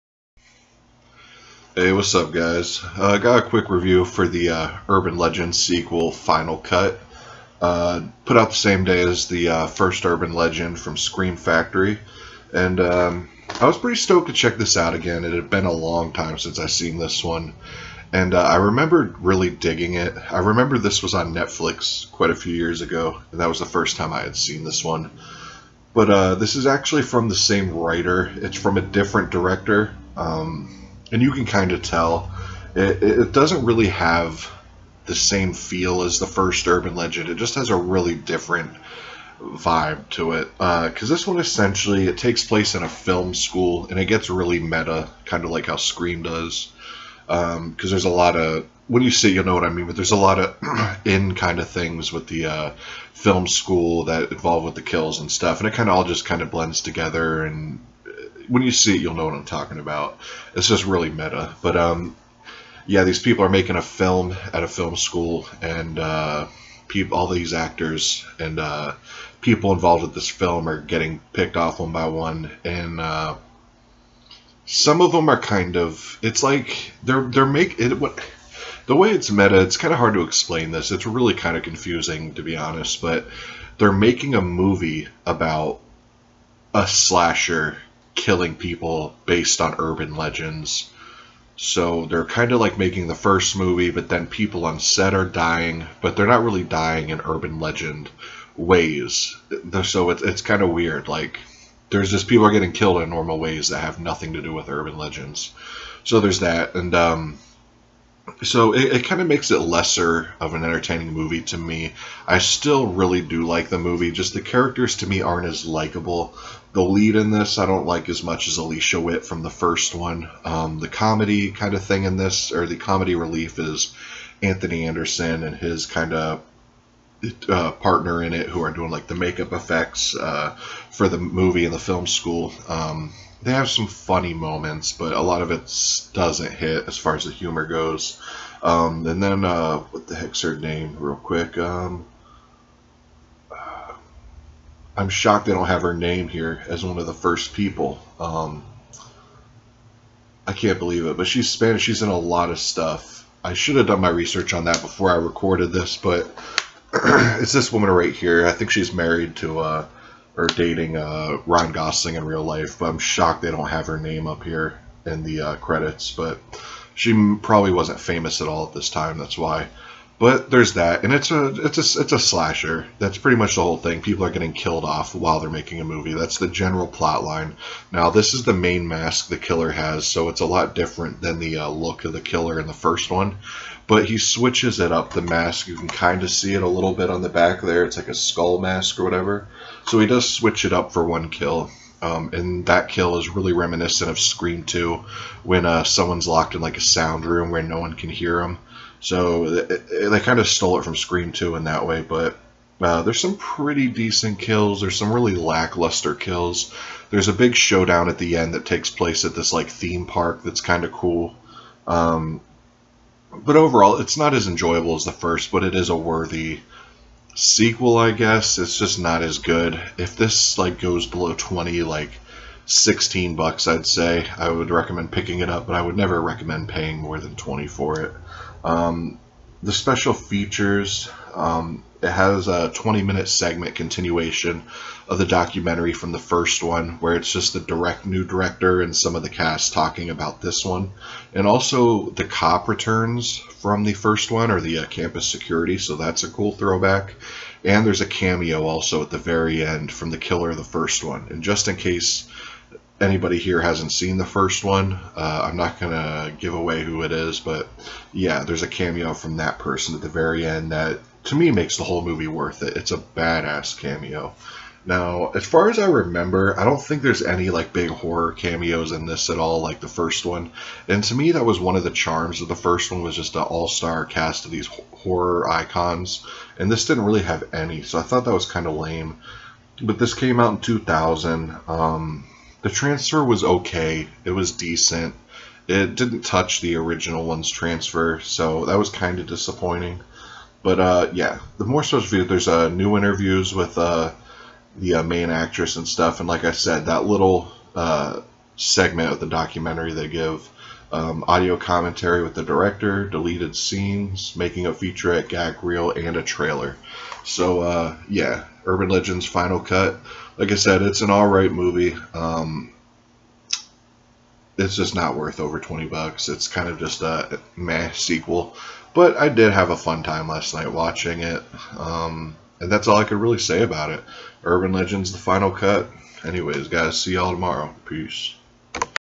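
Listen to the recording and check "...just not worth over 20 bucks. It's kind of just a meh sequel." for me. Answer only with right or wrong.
right.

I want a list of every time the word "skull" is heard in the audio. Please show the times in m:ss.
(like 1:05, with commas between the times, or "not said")
3:08.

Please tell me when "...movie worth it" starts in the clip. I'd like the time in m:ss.
4:22.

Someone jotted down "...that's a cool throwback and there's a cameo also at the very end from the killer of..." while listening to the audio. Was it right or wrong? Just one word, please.
right.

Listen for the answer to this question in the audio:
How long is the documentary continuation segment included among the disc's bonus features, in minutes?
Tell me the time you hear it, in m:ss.
3:52.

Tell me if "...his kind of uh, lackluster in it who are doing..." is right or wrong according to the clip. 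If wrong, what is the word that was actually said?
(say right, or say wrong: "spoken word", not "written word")
wrong: "partner", not "lackluster".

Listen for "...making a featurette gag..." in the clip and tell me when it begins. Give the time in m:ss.
5:04.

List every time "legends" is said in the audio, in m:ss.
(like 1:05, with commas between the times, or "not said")
0:05, 0:10, 0:36, 1:30, 1:37, 1:44, 5:08, 5:24.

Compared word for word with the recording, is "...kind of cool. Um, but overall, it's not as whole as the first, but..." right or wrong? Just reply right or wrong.
wrong.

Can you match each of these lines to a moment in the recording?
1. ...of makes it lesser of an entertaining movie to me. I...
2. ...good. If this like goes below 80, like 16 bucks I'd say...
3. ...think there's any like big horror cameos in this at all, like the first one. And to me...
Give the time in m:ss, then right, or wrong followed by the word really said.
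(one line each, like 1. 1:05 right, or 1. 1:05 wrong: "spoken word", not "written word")
1. 1:49 right
2. 3:39 wrong: "20", not "80"
3. 4:26 right.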